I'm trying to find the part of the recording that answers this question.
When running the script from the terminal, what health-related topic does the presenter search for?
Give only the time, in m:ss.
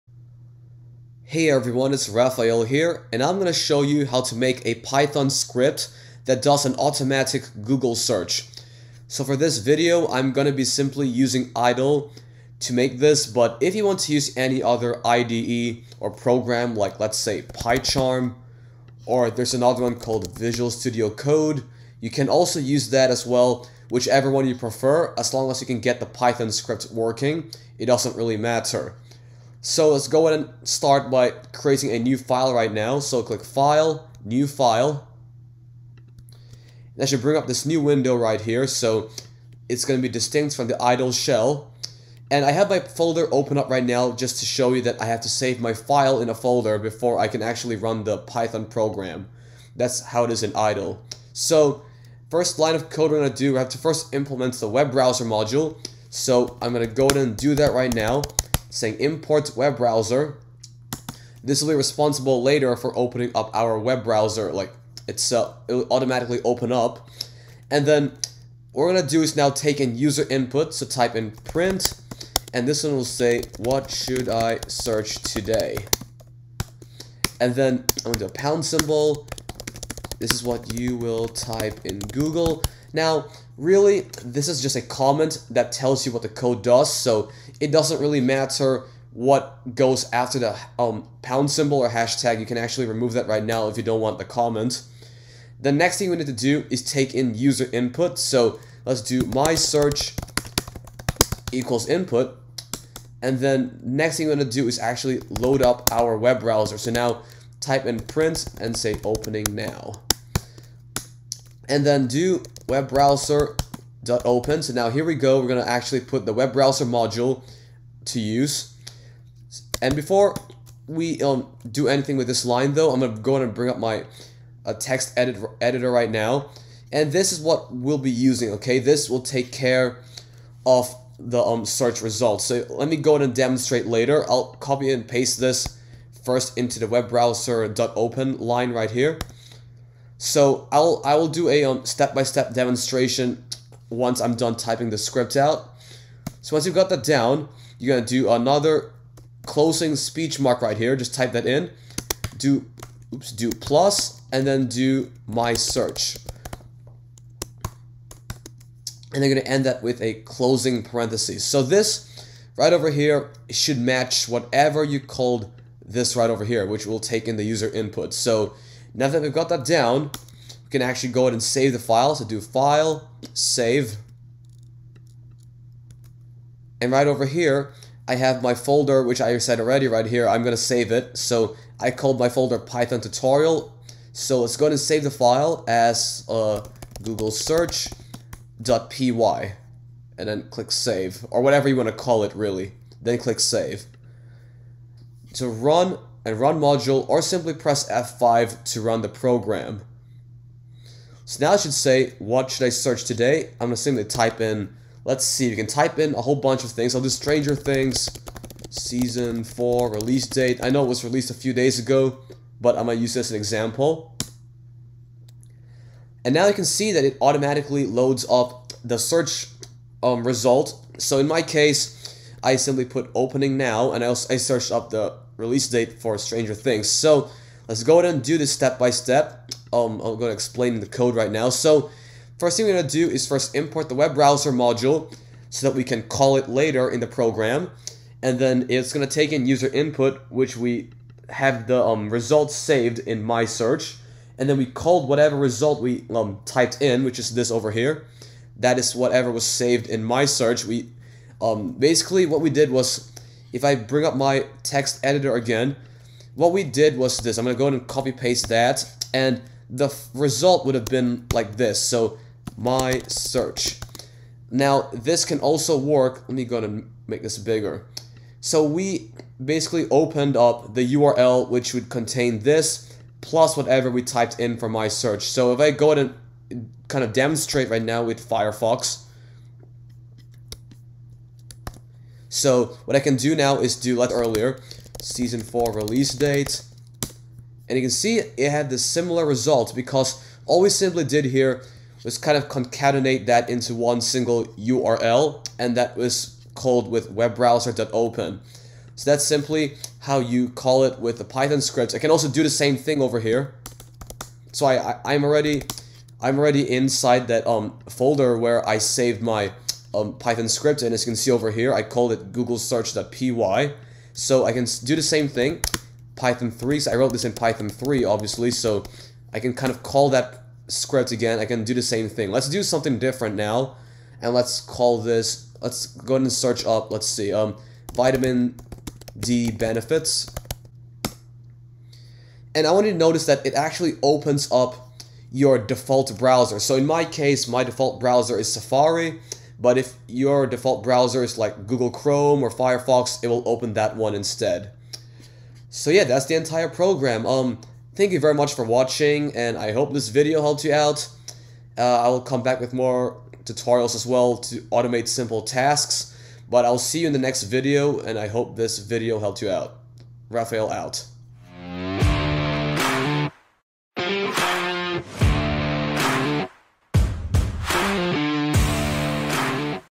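5:27.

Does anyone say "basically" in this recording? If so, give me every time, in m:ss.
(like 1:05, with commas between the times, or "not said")
4:11, 4:29.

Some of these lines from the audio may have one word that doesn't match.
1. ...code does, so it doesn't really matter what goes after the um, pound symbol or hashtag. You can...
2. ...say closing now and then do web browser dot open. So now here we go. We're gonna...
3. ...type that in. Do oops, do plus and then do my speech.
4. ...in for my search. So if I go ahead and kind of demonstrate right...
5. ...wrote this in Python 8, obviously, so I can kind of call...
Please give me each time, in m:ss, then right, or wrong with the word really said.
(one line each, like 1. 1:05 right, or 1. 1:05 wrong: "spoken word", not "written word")
1. 1:26 right
2. 1:48 wrong: "opening", not "closing"
3. 2:31 wrong: "search", not "speech"
4. 4:34 right
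5. 5:16 wrong: "3", not "8".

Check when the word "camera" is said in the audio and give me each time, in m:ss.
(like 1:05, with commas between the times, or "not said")
not said.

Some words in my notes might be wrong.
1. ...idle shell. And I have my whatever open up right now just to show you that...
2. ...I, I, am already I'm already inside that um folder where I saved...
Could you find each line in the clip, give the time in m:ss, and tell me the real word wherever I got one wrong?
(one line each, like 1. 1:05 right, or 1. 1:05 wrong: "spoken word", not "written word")
1. 0:40 wrong: "folder", not "whatever"
2. 5:04 right.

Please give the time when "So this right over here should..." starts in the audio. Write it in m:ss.
2:41.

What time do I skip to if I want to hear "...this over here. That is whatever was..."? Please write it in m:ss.
4:07.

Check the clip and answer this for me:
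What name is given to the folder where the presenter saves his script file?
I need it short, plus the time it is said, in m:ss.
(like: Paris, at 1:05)
Python tutorial, at 3:02.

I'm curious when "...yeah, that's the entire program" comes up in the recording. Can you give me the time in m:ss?
5:45.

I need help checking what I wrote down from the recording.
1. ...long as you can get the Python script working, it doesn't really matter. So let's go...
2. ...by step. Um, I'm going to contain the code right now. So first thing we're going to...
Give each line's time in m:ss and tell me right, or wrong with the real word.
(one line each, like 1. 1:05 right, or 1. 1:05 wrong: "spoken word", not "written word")
1. 0:25 right
2. 3:48 wrong: "explain", not "contain".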